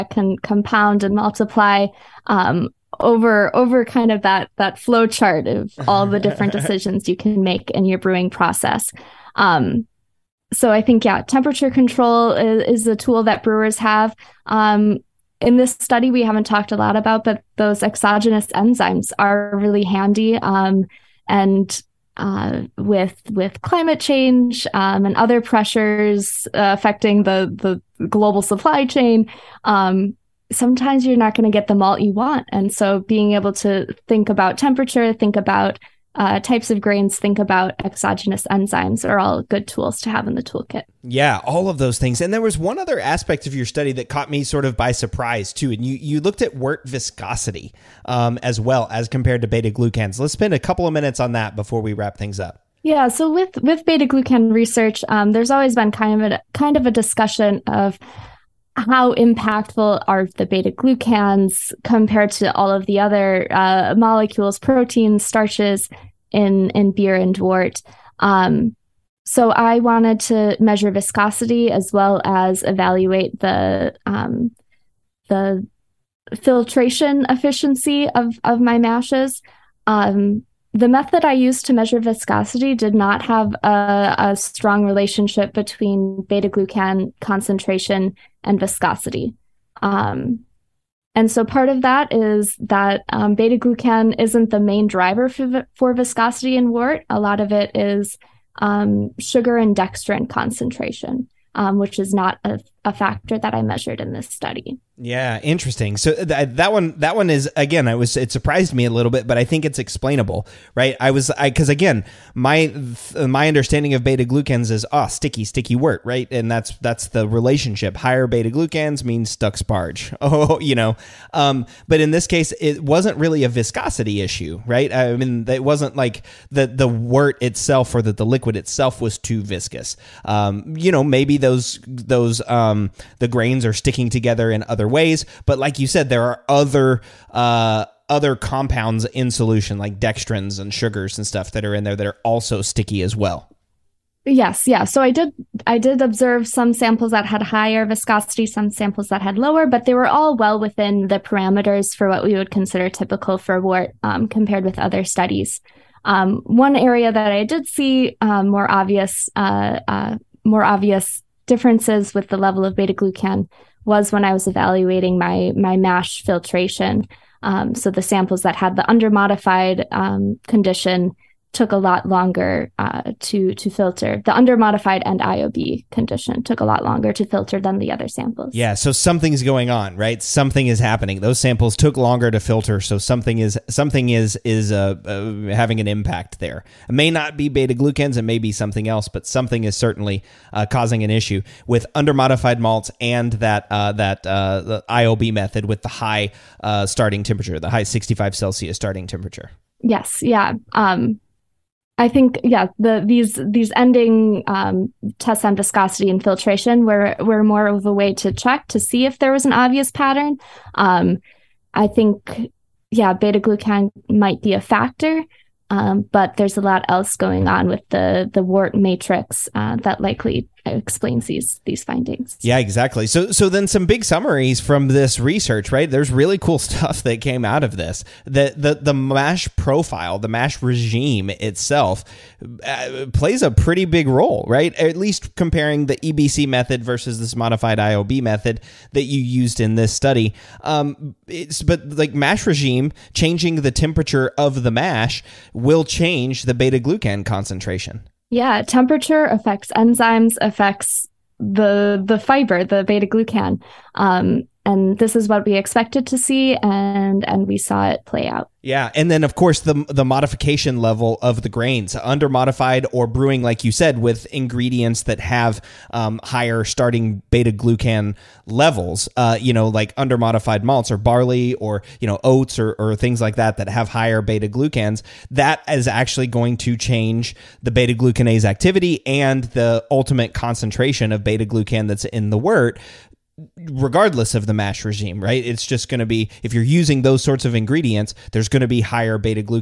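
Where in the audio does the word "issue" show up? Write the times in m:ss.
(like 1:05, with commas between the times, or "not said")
2:04, 3:11.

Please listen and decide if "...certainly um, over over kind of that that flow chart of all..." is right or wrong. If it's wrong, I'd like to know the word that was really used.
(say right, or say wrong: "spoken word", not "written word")
wrong: "multiply", not "certainly".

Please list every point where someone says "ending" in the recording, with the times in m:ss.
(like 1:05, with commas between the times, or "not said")
3:23.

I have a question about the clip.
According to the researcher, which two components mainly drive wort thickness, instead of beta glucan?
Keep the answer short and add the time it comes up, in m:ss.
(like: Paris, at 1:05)
Sugar and dextrin, at 1:39.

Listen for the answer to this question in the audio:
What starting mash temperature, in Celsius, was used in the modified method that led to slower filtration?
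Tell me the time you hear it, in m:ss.
3:17.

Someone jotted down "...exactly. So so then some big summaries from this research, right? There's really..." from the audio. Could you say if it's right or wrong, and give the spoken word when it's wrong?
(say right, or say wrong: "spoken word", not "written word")
right.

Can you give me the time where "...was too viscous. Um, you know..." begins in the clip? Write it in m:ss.
2:09.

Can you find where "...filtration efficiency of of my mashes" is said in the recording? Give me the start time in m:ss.
1:16.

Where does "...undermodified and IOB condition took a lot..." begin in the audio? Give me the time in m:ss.
2:54.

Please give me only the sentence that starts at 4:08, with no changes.
Yeah, temperature affects enzymes, affects the the fiber, the beta glucan.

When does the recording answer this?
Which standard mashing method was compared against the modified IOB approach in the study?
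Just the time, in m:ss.
3:55.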